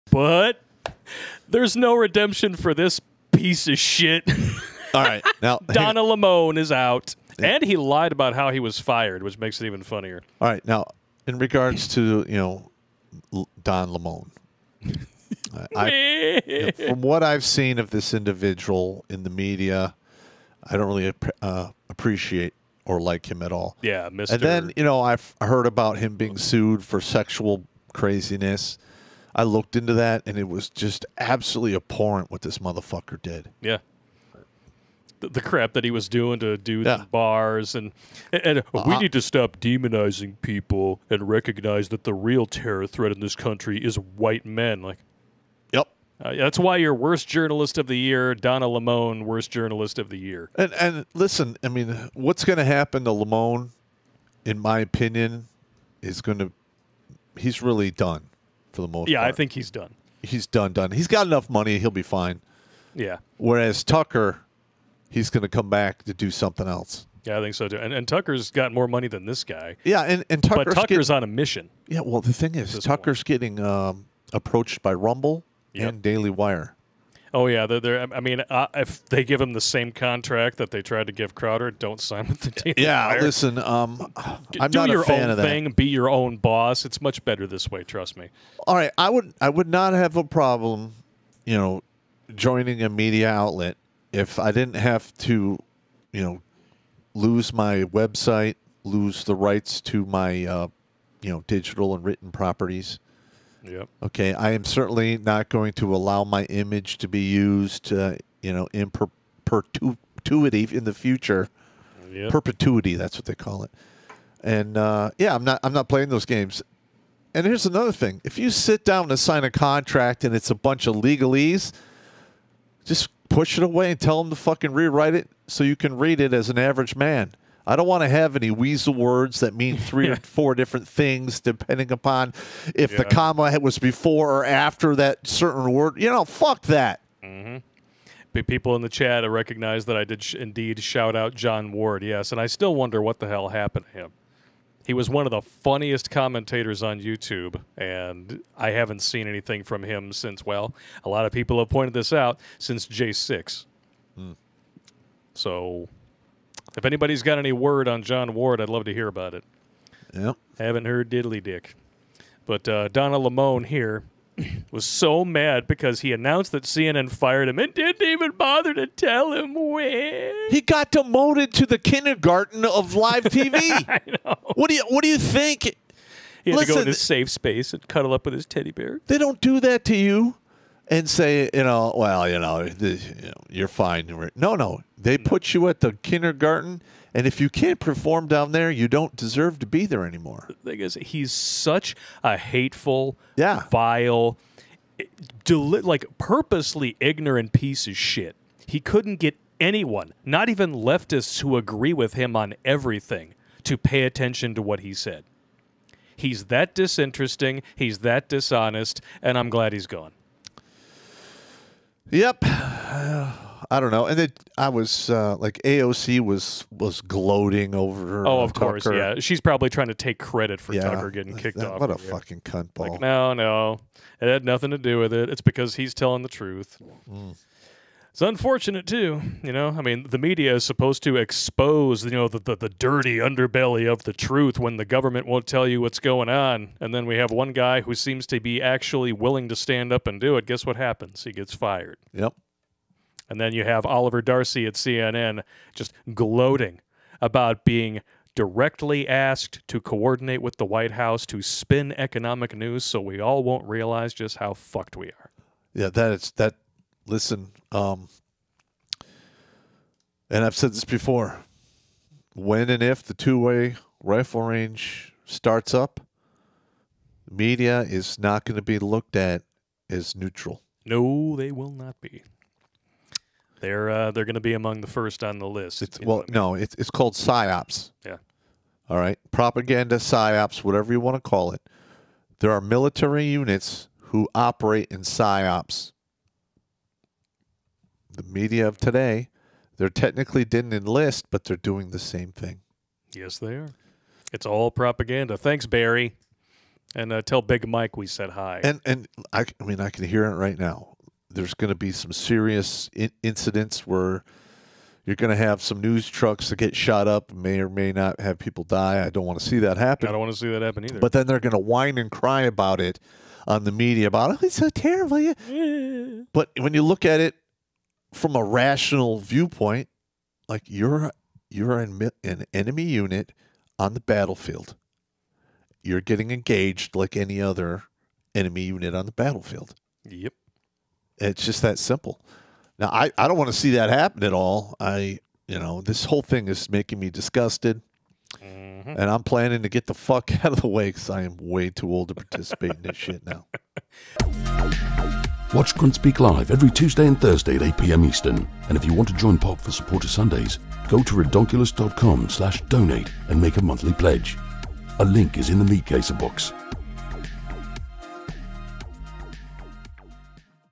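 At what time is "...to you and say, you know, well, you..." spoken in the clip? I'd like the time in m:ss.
2:59.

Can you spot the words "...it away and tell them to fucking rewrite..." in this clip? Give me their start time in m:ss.
2:03.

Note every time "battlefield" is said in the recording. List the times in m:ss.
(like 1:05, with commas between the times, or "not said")
5:23, 5:29.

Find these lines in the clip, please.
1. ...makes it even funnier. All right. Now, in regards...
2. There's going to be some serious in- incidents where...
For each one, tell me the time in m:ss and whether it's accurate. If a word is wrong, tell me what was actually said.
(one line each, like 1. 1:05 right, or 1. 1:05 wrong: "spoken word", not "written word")
1. 0:09 right
2. 5:01 right.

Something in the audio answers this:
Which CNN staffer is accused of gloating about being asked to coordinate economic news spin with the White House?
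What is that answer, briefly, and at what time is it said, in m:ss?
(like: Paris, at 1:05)
Oliver Darcy, at 4:03.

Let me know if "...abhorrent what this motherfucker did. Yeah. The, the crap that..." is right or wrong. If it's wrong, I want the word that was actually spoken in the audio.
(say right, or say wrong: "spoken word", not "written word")
right.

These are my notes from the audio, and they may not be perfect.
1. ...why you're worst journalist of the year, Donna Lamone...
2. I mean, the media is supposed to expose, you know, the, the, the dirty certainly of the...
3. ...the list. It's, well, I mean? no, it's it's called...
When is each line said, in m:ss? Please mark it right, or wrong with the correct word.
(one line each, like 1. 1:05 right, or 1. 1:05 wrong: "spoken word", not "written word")
1. 0:46 right
2. 3:49 wrong: "underbelly", not "certainly"
3. 4:35 right.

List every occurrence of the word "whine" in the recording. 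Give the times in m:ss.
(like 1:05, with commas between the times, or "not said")
5:11.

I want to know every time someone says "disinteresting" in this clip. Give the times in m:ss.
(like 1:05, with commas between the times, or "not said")
3:26.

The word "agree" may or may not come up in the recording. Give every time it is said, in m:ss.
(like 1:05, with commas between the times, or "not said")
3:21.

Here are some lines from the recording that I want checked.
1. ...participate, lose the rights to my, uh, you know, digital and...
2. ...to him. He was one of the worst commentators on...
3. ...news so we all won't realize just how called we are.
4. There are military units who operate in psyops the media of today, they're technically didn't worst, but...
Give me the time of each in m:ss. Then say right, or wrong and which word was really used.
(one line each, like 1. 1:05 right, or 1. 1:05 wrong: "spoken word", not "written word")
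1. 1:37 wrong: "website", not "participate"
2. 2:23 wrong: "funniest", not "worst"
3. 4:12 wrong: "fucked", not "called"
4. 4:42 wrong: "enlist", not "worst".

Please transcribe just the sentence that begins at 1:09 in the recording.
Yeah, and, and Tucker's, but Tucker's on a mission.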